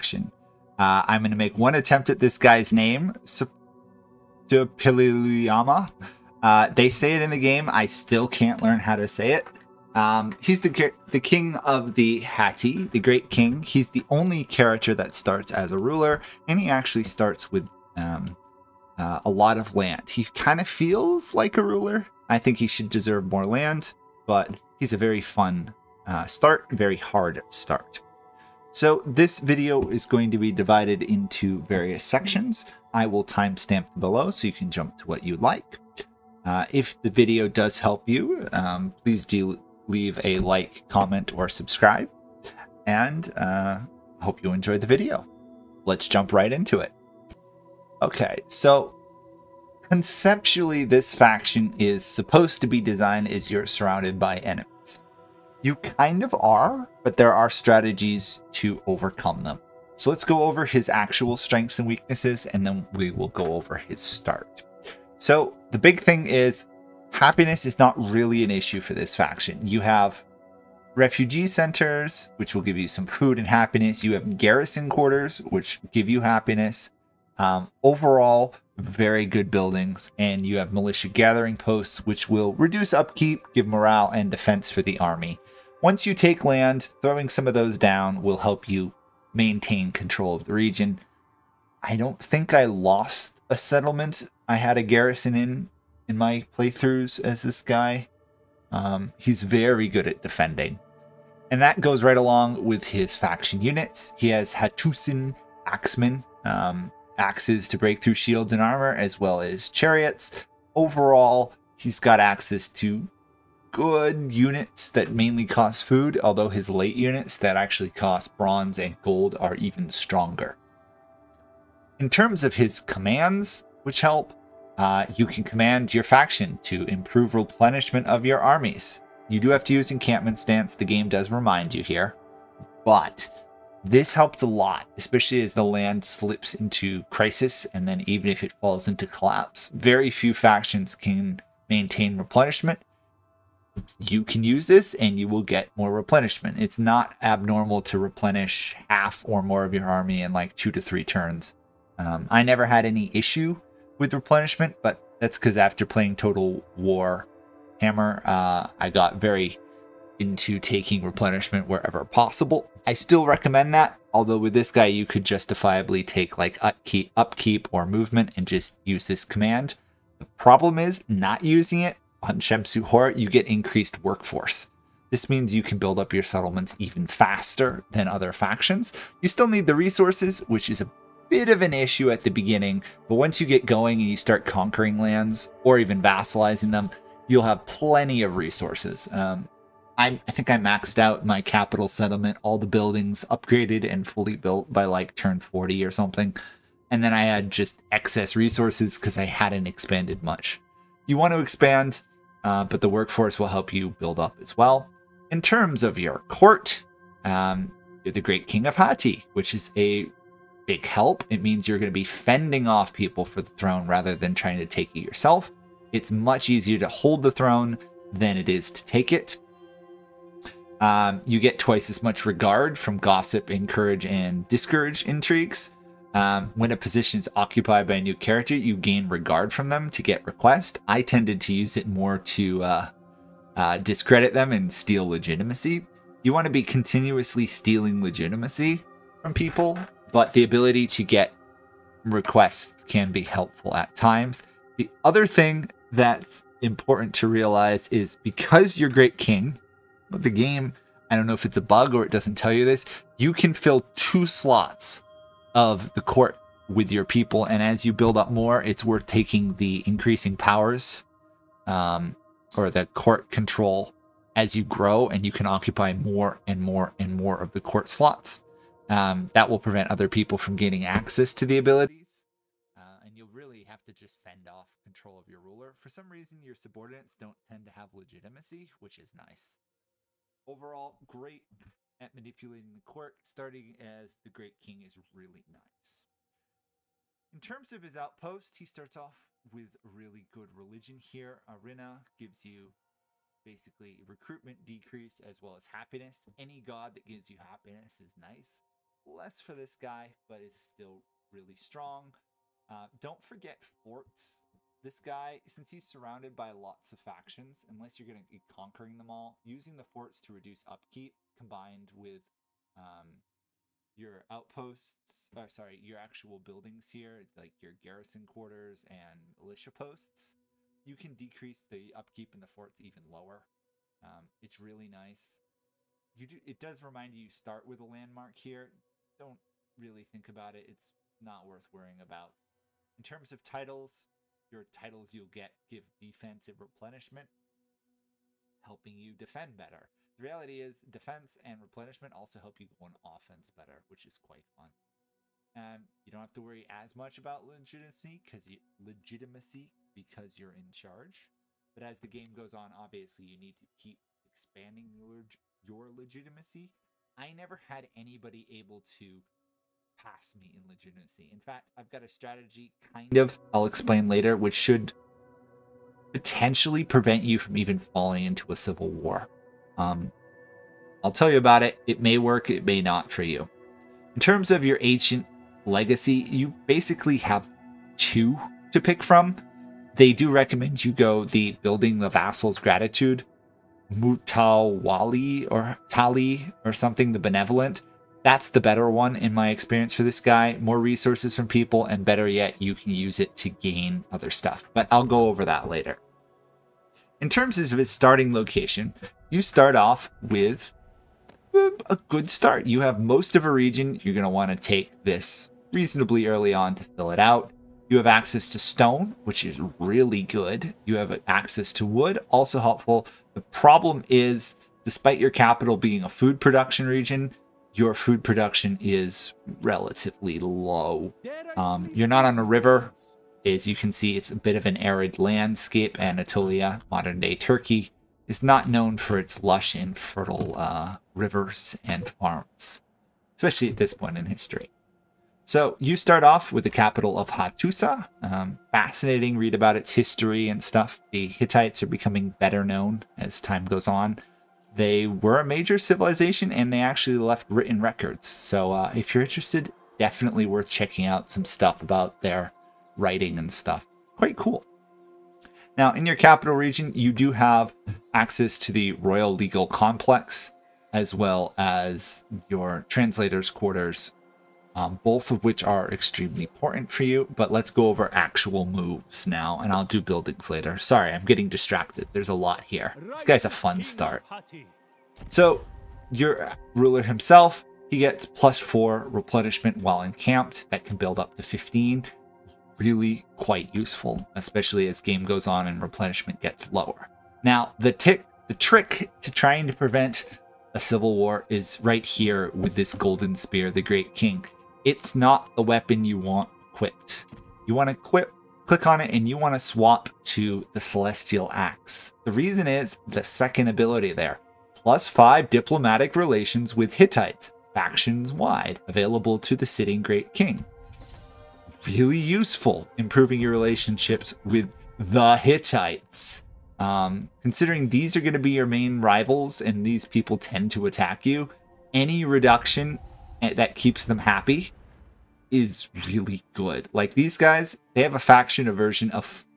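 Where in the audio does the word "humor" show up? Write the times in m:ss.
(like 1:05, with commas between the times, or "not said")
not said.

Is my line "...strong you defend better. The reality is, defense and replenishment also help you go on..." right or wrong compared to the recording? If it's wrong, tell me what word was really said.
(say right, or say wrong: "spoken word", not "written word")
wrong: "helping", not "strong".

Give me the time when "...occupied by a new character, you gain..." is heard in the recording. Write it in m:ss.
3:47.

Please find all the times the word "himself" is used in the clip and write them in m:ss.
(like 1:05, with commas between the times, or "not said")
7:57.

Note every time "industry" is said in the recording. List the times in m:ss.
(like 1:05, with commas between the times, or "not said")
not said.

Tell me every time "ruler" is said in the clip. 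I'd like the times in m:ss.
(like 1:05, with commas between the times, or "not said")
0:15, 0:21, 4:35, 7:56.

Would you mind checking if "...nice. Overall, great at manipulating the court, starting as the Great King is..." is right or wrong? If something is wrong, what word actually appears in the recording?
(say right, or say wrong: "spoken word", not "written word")
right.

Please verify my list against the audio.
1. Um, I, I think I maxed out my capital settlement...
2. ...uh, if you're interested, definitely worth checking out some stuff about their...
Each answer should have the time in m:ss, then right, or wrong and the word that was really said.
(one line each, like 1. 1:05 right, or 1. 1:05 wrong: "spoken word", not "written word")
1. 3:09 right
2. 7:28 right.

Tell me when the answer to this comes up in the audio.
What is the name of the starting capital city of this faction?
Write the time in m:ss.
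7:17.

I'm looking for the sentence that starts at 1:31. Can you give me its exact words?
I don't think I lost a settlement I had a garrison in in my playthroughs as this guy.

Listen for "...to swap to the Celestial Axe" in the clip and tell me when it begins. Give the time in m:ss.
8:19.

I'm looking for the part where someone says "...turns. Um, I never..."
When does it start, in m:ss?
2:31.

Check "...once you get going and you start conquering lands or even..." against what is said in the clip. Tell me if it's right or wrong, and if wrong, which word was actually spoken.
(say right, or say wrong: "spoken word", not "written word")
right.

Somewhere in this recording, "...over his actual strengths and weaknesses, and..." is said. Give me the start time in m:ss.
1:00.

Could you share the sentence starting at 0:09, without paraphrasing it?
Um, he's the the king of the Hatti, the great king.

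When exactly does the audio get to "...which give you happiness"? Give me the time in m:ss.
1:15.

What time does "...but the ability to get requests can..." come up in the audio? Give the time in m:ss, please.
4:00.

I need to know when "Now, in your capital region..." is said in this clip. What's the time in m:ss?
7:35.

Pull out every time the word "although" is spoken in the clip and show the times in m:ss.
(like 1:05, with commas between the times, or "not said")
1:56, 2:44.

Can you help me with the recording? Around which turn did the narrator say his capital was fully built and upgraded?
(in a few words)
40.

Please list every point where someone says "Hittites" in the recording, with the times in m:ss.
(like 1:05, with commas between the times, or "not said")
7:21, 8:26, 8:35.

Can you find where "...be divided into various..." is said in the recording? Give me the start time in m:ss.
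0:30.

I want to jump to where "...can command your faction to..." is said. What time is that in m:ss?
2:05.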